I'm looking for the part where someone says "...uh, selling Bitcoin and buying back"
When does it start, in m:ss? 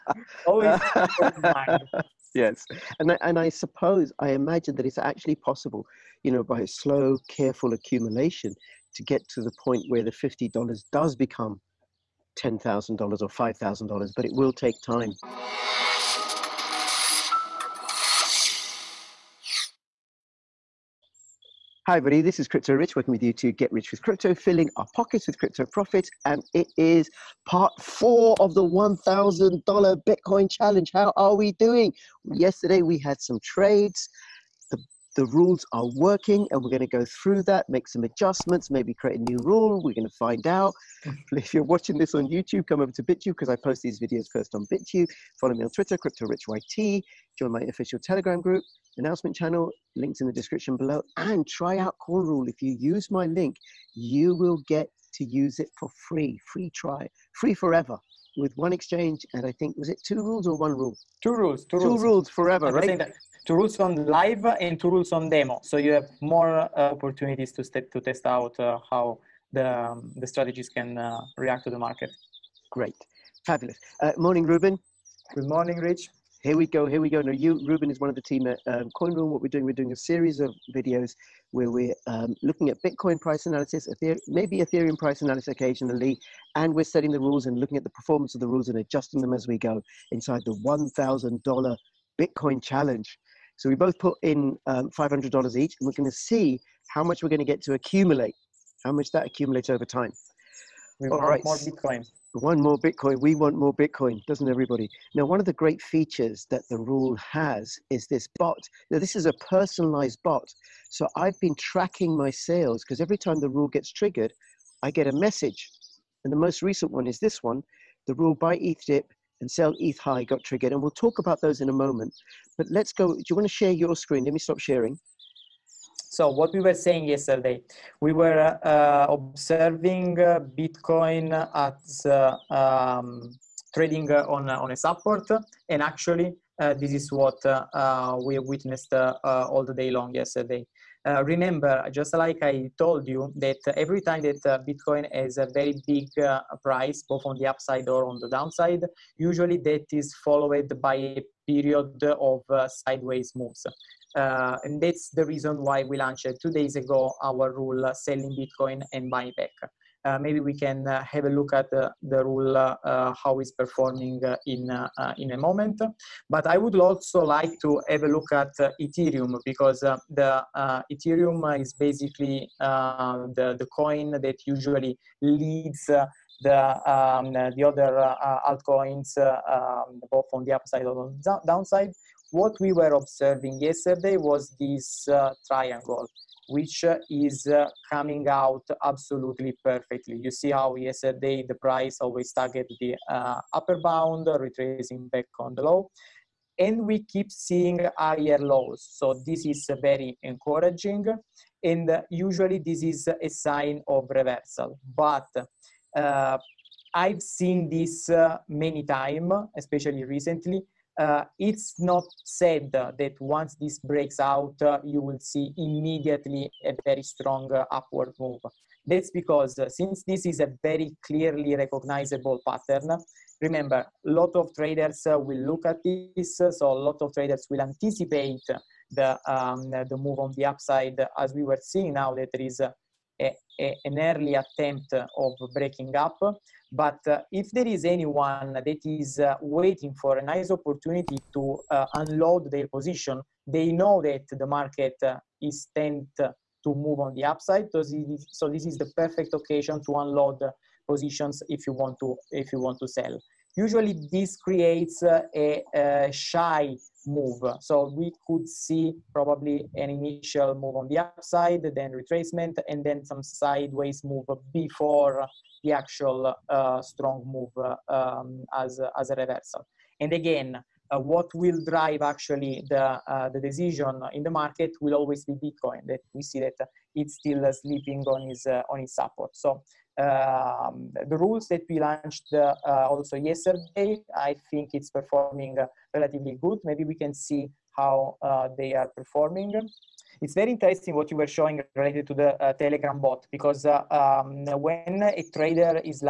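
2:37.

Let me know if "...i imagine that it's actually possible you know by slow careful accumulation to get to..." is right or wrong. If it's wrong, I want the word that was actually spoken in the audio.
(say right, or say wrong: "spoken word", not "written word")
right.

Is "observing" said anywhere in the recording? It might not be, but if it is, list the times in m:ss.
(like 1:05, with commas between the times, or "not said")
2:09, 3:02.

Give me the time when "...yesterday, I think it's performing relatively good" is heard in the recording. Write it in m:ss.
4:43.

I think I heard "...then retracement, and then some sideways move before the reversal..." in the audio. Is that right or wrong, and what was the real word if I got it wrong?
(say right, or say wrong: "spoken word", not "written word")
wrong: "actual", not "reversal".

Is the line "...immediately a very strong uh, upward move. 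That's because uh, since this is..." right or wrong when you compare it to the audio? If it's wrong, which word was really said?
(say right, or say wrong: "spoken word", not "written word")
right.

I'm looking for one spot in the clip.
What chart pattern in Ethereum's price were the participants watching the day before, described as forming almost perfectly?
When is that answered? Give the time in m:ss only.
3:05.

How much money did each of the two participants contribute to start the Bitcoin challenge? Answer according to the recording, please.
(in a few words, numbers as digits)
$500.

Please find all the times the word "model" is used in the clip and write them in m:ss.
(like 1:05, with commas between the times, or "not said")
not said.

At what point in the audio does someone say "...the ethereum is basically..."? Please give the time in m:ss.
2:49.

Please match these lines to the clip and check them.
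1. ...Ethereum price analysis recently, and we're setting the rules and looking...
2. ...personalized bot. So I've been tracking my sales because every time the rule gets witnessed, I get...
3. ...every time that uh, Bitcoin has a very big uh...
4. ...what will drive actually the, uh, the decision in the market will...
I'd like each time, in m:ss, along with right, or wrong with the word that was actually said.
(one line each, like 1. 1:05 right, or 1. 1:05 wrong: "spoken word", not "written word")
1. 1:24 wrong: "occasionally", not "recently"
2. 1:49 wrong: "triggered", not "witnessed"
3. 2:23 right
4. 4:30 right.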